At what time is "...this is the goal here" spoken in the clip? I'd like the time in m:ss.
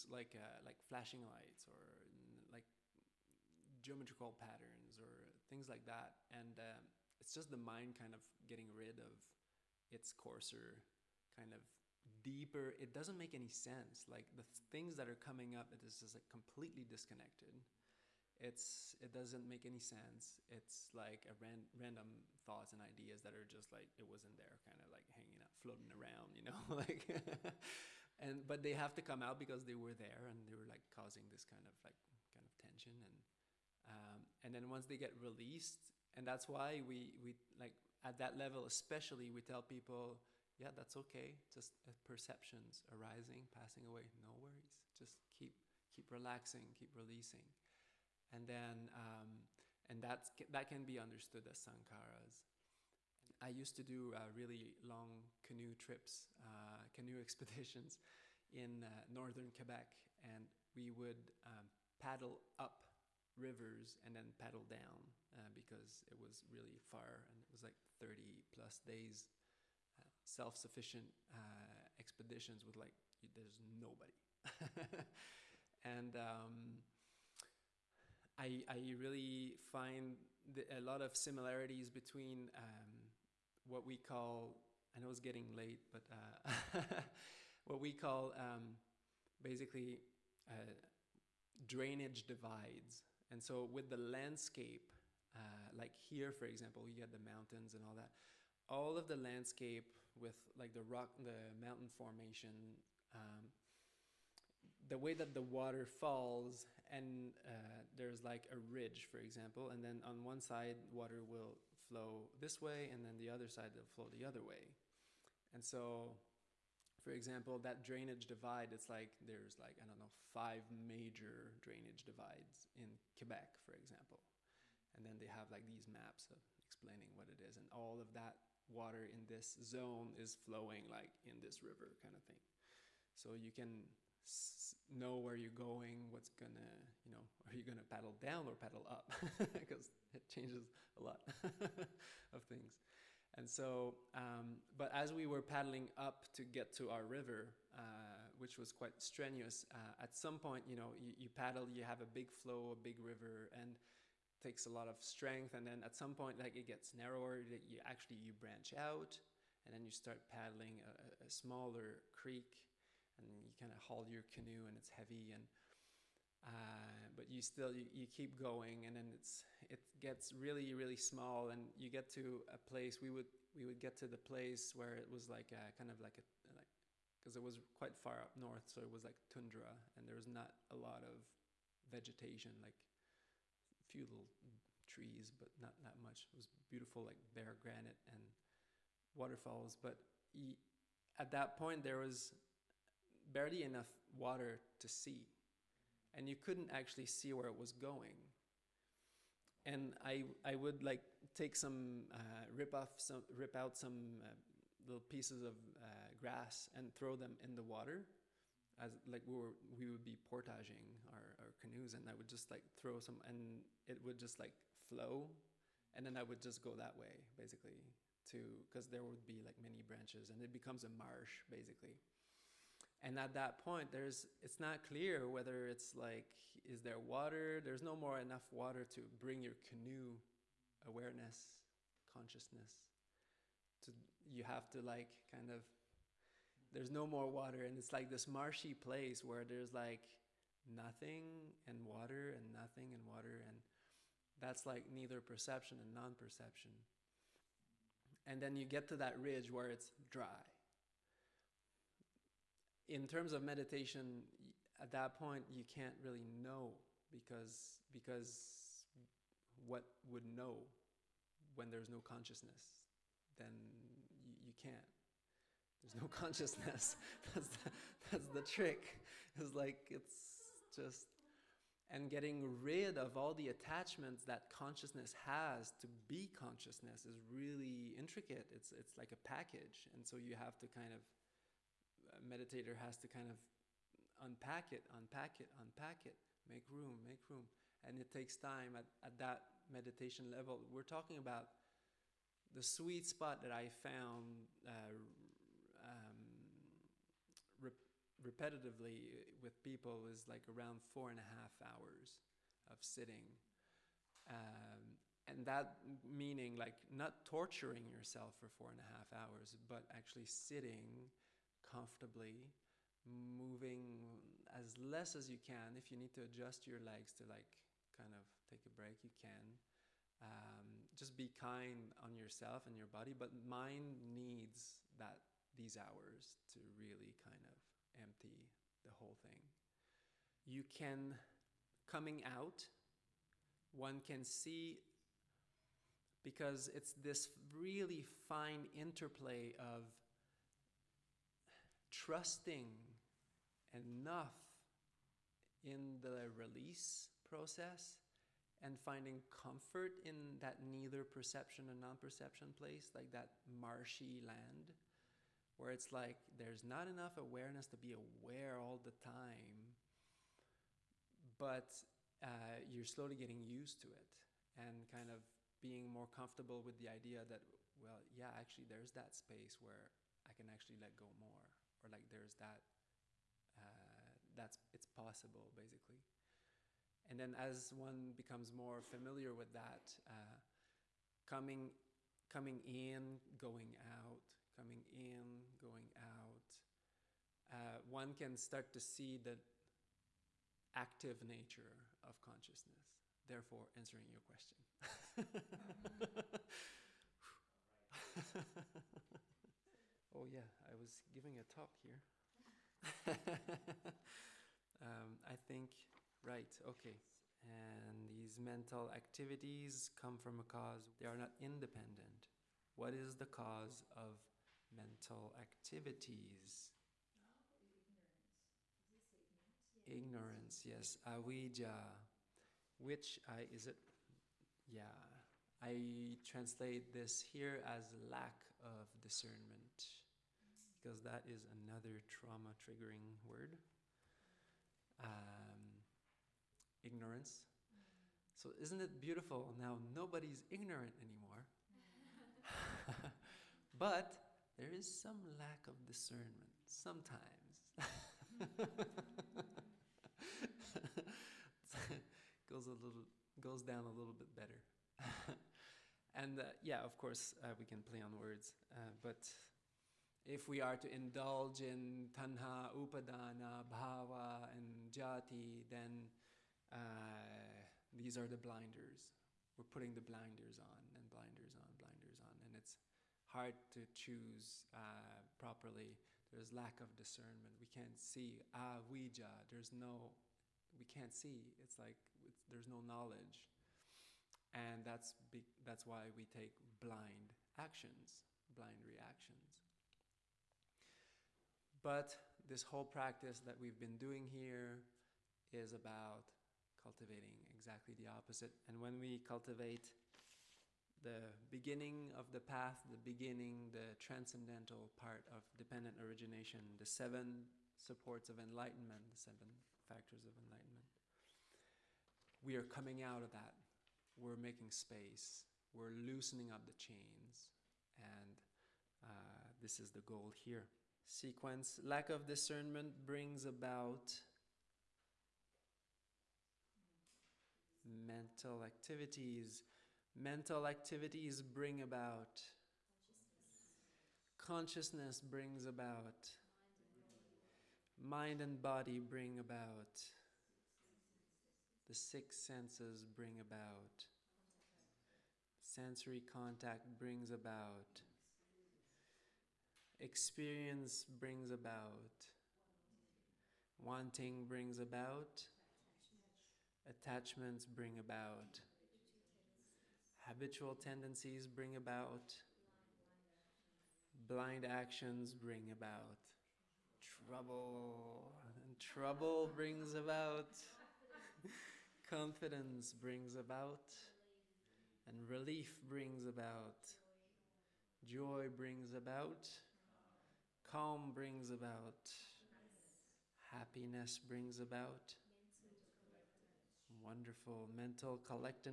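8:39.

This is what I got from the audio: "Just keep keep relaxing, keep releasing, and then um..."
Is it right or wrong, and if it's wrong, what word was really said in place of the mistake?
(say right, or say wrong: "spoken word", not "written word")
right.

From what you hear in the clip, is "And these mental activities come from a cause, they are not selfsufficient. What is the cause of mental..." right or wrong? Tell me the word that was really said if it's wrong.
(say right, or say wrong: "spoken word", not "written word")
wrong: "independent", not "selfsufficient".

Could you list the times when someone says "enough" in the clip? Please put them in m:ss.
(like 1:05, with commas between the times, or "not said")
3:13, 3:48, 5:43, 5:56.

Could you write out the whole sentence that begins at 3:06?
It was beautiful, like bare granite and waterfalls.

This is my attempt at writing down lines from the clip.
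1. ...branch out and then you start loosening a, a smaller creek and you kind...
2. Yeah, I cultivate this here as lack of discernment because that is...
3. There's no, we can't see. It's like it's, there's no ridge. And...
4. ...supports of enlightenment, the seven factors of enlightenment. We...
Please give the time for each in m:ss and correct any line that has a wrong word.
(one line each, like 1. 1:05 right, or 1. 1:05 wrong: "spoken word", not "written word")
1. 2:38 wrong: "paddling", not "loosening"
2. 7:04 wrong: "translate", not "cultivate"
3. 7:59 wrong: "knowledge", not "ridge"
4. 8:27 right.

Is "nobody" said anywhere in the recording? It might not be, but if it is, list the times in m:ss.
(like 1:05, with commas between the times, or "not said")
1:13, 7:19.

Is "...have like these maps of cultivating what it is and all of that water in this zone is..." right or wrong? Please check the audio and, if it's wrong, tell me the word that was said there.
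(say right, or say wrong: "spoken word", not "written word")
wrong: "explaining", not "cultivating".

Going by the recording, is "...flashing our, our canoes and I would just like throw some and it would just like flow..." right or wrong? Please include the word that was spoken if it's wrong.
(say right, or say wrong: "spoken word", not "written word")
wrong: "portaging", not "flashing".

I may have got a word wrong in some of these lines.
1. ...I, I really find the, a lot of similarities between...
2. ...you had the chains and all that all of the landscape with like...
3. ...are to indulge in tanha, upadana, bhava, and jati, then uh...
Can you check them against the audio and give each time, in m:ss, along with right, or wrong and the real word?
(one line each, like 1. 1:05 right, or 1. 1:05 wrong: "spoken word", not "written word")
1. 1:18 right
2. 1:36 wrong: "mountains", not "chains"
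3. 7:40 right.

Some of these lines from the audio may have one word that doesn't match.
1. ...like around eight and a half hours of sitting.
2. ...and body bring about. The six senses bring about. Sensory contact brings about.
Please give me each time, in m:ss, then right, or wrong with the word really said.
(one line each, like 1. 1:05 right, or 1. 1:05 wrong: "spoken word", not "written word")
1. 5:00 wrong: "four", not "eight"
2. 8:58 right.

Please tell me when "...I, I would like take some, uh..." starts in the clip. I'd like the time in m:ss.
3:20.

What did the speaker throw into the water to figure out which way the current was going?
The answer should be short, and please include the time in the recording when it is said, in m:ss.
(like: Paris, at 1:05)
Grass, at 3:26.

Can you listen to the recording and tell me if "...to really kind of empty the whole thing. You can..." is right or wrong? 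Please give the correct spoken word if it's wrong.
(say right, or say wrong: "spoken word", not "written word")
right.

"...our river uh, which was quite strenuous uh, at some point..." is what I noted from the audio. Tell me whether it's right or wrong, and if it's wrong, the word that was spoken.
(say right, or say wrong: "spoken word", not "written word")
right.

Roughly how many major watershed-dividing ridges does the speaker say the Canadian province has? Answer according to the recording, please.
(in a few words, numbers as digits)
5.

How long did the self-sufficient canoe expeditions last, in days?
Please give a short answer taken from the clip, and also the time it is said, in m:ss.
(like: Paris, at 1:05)
30+ days, at 1:07.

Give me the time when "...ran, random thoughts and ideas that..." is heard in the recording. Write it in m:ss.
0:21.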